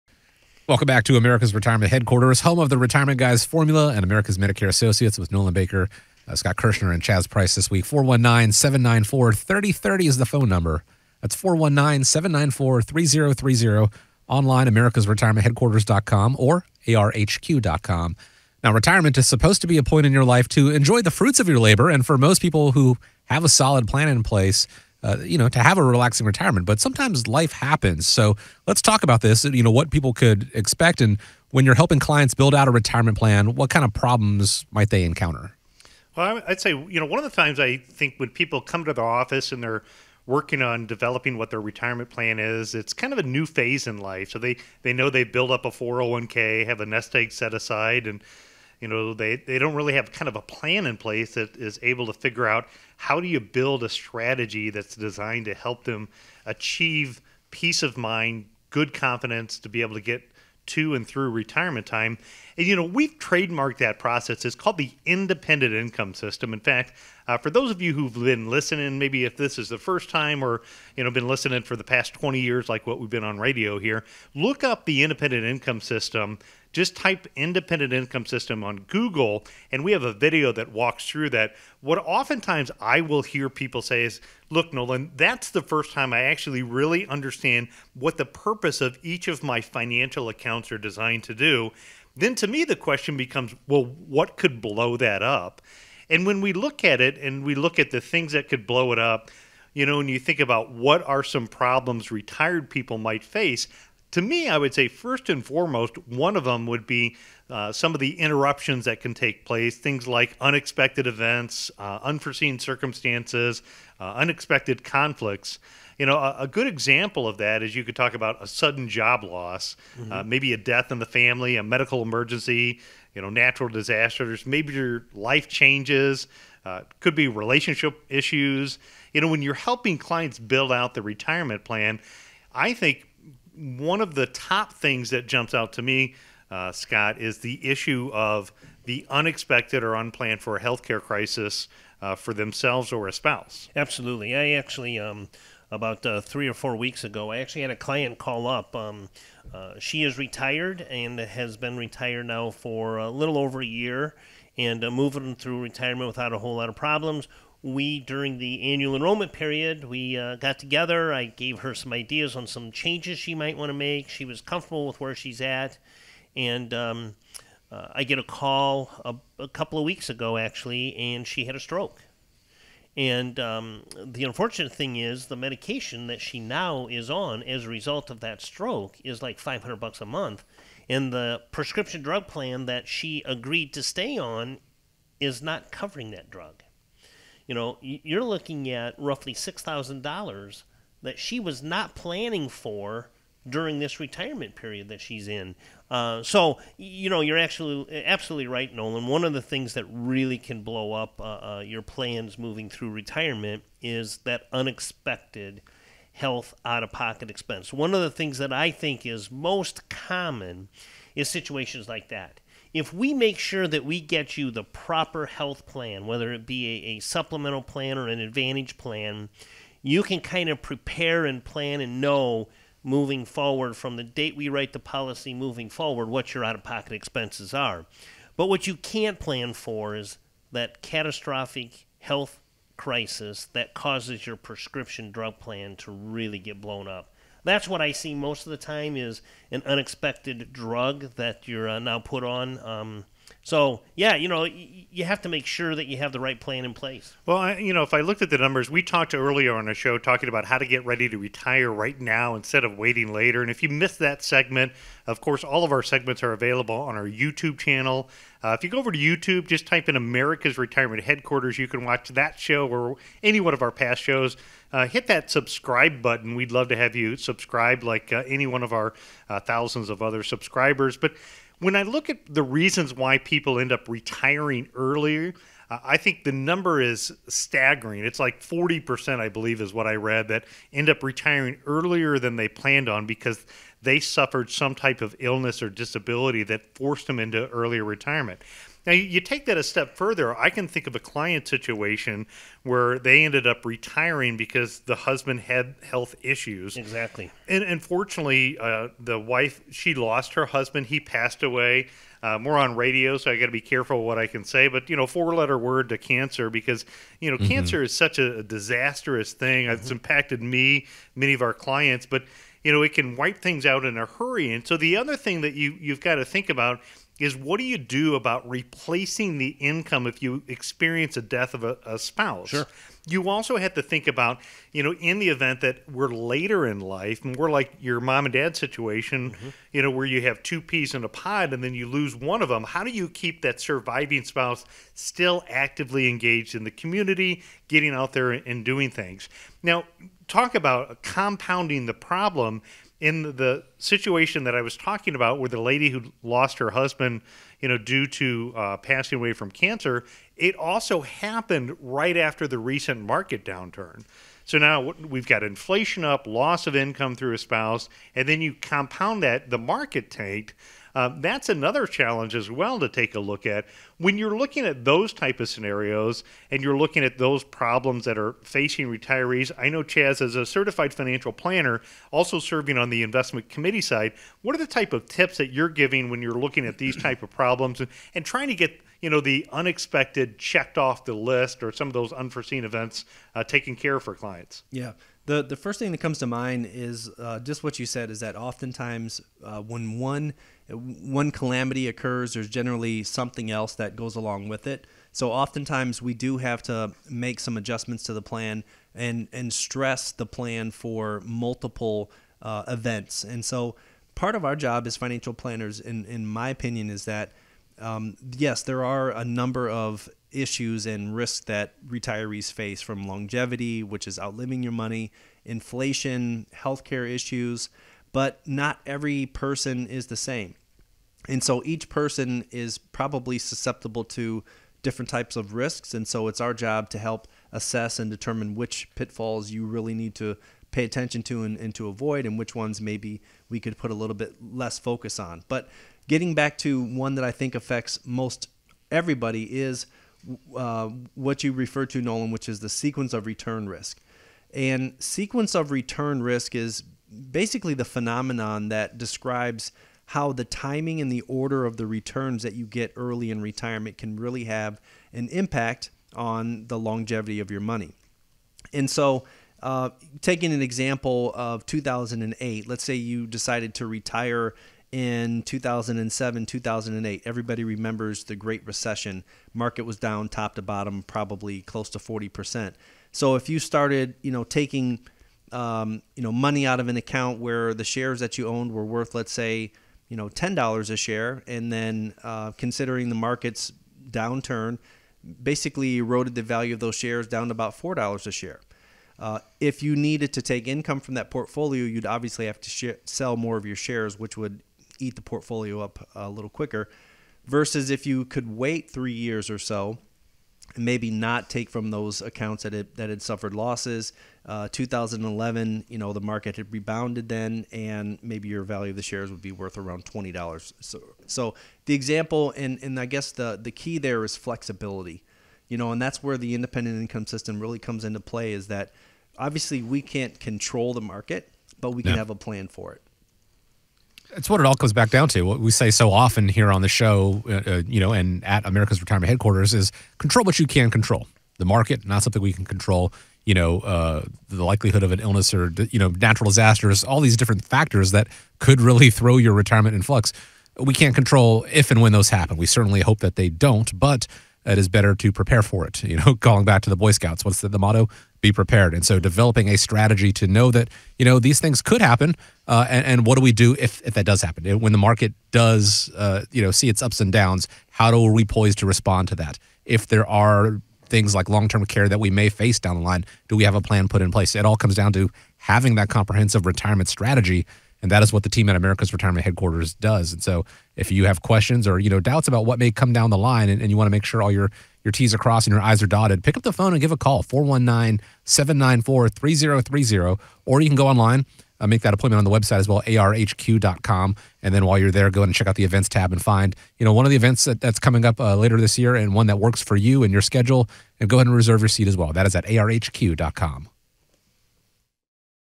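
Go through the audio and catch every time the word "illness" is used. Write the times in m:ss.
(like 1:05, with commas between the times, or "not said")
4:45, 8:55.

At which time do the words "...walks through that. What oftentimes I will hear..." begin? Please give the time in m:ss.
1:20.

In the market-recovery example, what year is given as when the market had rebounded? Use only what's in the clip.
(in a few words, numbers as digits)
2011.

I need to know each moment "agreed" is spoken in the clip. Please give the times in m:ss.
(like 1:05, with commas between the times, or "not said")
3:03.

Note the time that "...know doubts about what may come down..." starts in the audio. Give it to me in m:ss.
9:32.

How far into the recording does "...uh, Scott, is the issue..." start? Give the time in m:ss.
2:16.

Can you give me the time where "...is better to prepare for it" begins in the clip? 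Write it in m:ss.
9:04.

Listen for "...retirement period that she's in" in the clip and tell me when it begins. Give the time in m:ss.
3:13.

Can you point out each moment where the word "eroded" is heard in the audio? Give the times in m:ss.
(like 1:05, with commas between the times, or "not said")
8:05.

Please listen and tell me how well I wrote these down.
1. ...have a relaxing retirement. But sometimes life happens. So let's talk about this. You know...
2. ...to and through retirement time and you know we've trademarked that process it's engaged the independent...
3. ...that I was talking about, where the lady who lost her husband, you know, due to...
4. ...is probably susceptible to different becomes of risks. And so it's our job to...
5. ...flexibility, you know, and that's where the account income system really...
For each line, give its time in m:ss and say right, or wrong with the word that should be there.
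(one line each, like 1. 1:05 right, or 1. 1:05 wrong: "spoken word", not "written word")
1. 0:25 right
2. 1:00 wrong: "called", not "engaged"
3. 5:44 right
4. 7:02 wrong: "types", not "becomes"
5. 8:34 wrong: "independent", not "account".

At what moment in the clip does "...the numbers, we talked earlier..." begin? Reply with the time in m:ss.
4:08.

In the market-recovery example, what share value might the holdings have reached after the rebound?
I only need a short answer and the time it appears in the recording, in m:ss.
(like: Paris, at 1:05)
$20, at 8:30.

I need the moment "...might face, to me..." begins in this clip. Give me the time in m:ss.
1:42.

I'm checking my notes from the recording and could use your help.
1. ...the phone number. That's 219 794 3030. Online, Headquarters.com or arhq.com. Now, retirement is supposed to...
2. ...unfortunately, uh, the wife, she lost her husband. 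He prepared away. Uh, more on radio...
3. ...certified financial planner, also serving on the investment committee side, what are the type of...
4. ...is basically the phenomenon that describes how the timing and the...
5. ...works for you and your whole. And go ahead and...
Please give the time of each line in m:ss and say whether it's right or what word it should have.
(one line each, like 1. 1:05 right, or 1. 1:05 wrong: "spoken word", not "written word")
1. 0:10 wrong: "419", not "219"
2. 4:57 wrong: "passed", not "prepared"
3. 6:10 right
4. 7:26 right
5. 9:49 wrong: "schedule", not "whole".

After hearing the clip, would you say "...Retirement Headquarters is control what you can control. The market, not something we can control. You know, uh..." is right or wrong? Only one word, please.
right.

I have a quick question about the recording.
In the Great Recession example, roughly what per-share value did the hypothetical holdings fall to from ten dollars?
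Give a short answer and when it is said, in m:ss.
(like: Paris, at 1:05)
$4, at 8:07.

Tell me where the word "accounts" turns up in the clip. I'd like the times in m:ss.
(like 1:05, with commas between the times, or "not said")
1:30, 7:56, 8:22.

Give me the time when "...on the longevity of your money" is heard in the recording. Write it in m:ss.
7:36.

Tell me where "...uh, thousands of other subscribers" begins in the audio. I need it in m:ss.
4:29.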